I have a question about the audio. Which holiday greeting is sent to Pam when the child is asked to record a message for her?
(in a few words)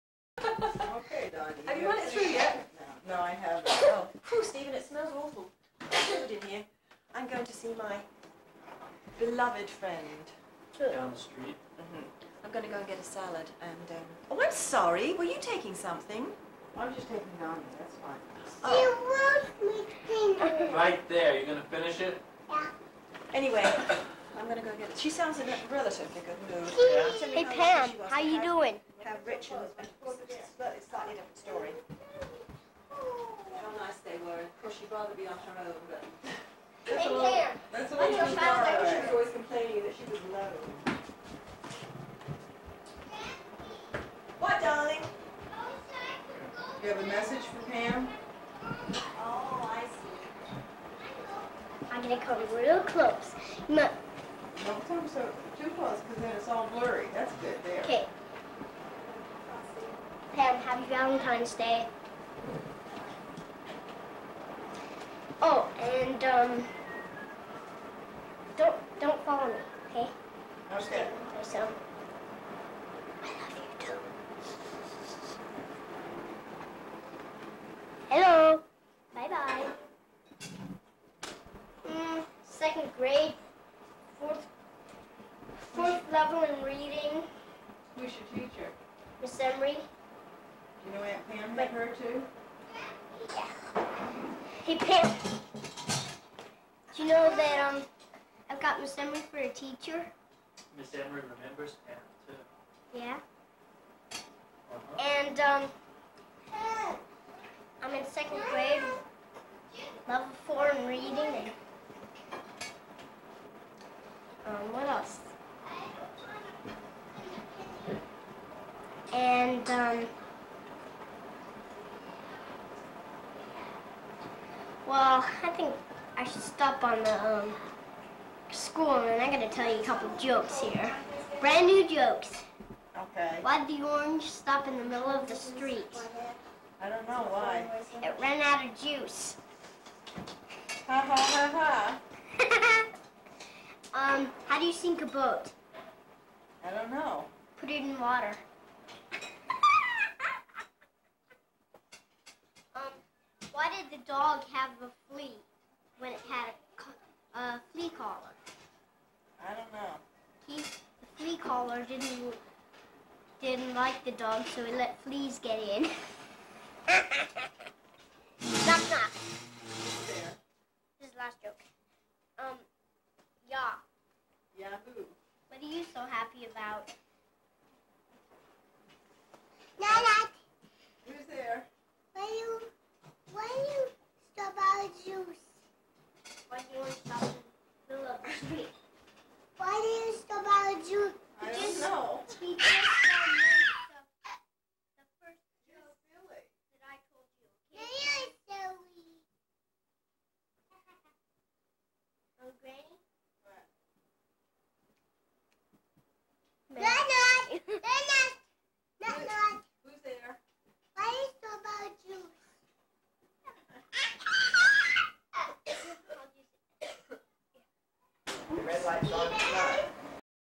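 Valentine's Day.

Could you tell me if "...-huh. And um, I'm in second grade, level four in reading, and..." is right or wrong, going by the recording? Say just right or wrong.
right.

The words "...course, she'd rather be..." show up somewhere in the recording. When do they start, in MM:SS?
00:34.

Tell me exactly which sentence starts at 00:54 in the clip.
Don't come so too close because then it's all blurry.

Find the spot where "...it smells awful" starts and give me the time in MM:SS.
00:04.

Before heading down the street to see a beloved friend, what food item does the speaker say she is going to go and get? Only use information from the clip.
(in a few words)
salad.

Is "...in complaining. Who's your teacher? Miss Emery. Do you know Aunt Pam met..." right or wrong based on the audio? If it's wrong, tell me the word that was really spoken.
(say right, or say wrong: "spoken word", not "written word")
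wrong: "reading", not "complaining".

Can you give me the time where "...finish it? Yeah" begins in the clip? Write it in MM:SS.
00:21.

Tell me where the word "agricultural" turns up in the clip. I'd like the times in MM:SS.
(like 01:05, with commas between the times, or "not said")
not said.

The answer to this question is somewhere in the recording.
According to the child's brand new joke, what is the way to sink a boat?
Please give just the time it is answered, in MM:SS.
02:27.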